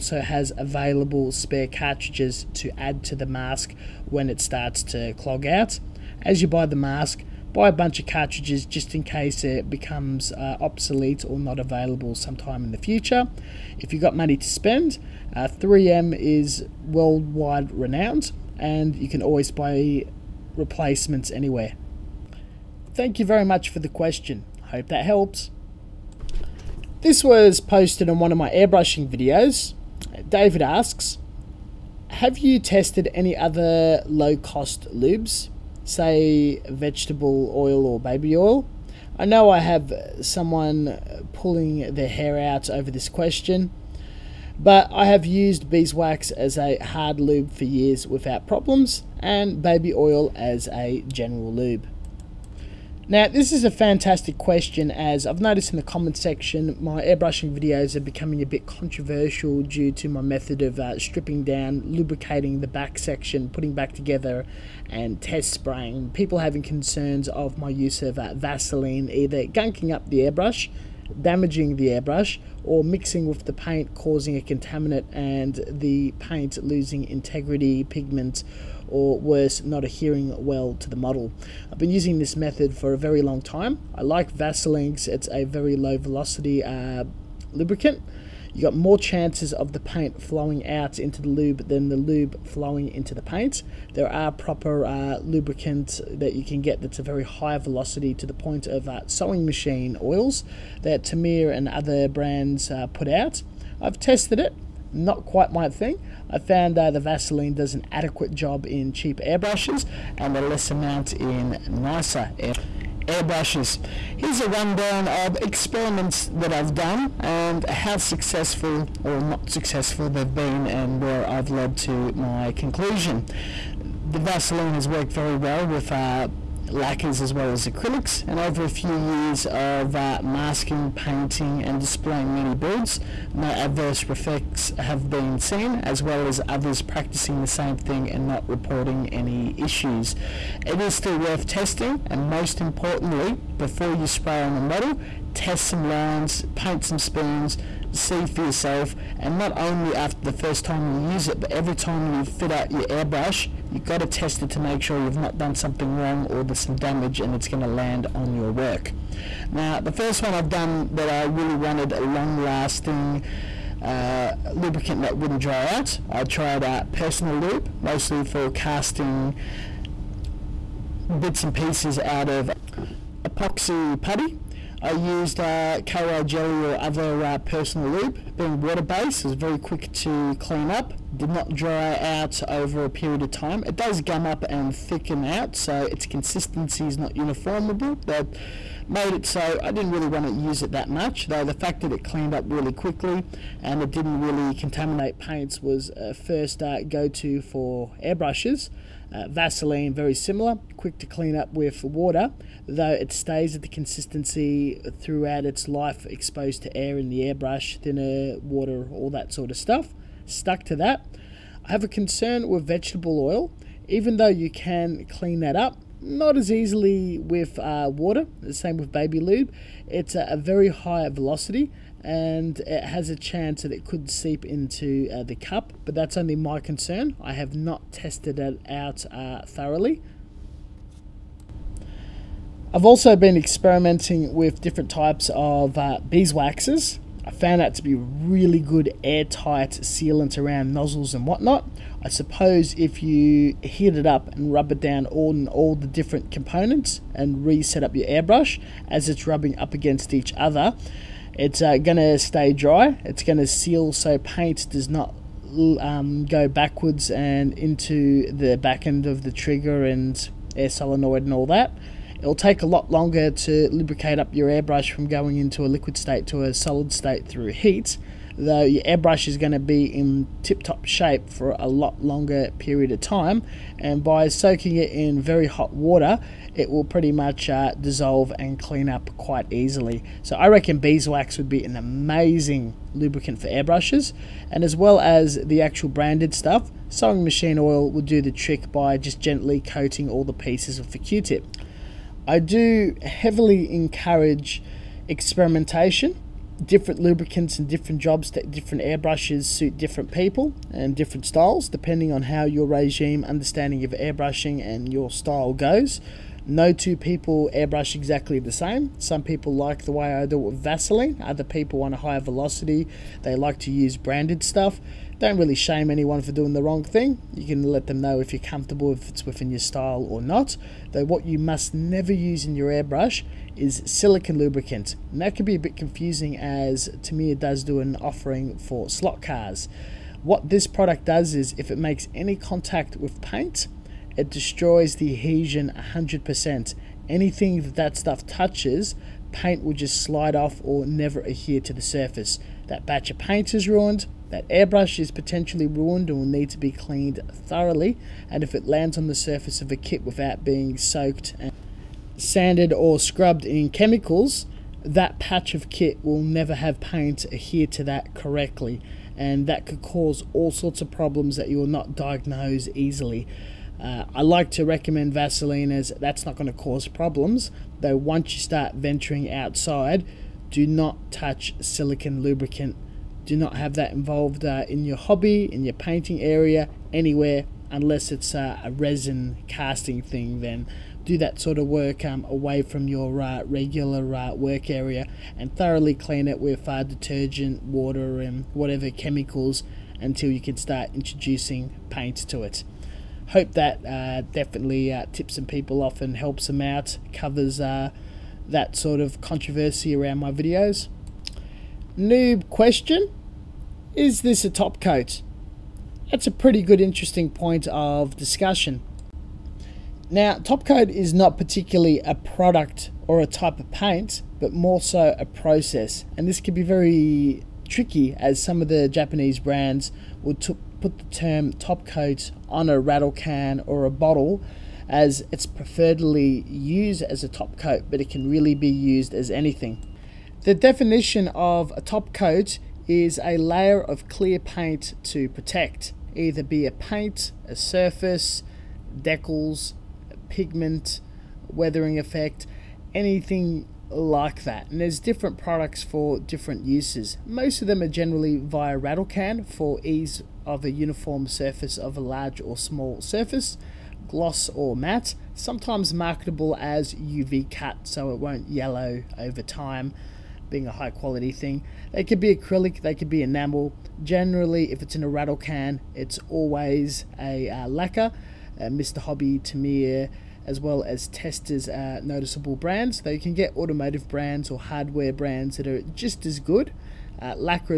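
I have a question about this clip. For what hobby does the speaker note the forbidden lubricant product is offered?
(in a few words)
Slot cars.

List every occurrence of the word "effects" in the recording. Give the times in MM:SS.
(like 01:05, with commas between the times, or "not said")
02:14, 07:21.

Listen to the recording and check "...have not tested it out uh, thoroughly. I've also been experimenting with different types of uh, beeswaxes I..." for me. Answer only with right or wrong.
right.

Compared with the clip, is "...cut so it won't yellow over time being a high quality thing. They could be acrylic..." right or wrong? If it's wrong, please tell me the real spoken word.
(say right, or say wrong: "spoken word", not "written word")
right.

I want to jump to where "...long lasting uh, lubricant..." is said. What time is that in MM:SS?
02:42.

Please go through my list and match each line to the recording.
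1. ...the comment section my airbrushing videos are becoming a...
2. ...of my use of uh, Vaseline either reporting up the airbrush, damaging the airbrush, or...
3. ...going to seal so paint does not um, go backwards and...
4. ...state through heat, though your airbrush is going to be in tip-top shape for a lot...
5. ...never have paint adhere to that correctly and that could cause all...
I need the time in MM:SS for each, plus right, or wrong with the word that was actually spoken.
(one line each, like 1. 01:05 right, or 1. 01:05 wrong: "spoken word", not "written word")
1. 00:55 right
2. 01:07 wrong: "gunking", not "reporting"
3. 04:13 right
4. 04:26 right
5. 05:56 right.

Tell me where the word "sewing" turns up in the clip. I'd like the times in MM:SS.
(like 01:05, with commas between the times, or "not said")
01:39, 04:46.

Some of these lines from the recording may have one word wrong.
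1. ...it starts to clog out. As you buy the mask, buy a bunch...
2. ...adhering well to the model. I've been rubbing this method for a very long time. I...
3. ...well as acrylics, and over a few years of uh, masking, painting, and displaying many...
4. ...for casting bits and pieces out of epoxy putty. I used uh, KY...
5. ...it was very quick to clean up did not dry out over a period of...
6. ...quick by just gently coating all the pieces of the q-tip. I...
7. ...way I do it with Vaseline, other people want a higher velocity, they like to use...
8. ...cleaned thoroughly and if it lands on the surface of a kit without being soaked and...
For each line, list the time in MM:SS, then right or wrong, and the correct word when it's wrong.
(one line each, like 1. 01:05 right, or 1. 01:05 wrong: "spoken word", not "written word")
1. 00:04 right
2. 01:19 wrong: "using", not "rubbing"
3. 02:07 right
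4. 02:48 right
5. 02:59 right
6. 04:48 wrong: "trick", not "quick"
7. 05:09 right
8. 05:46 right.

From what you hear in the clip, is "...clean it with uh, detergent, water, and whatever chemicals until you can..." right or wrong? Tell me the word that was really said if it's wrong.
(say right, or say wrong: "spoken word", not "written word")
right.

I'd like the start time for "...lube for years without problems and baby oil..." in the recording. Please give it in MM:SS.
00:47.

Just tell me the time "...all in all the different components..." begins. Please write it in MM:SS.
04:05.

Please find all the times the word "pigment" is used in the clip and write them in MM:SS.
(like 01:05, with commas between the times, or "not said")
01:17, 07:20.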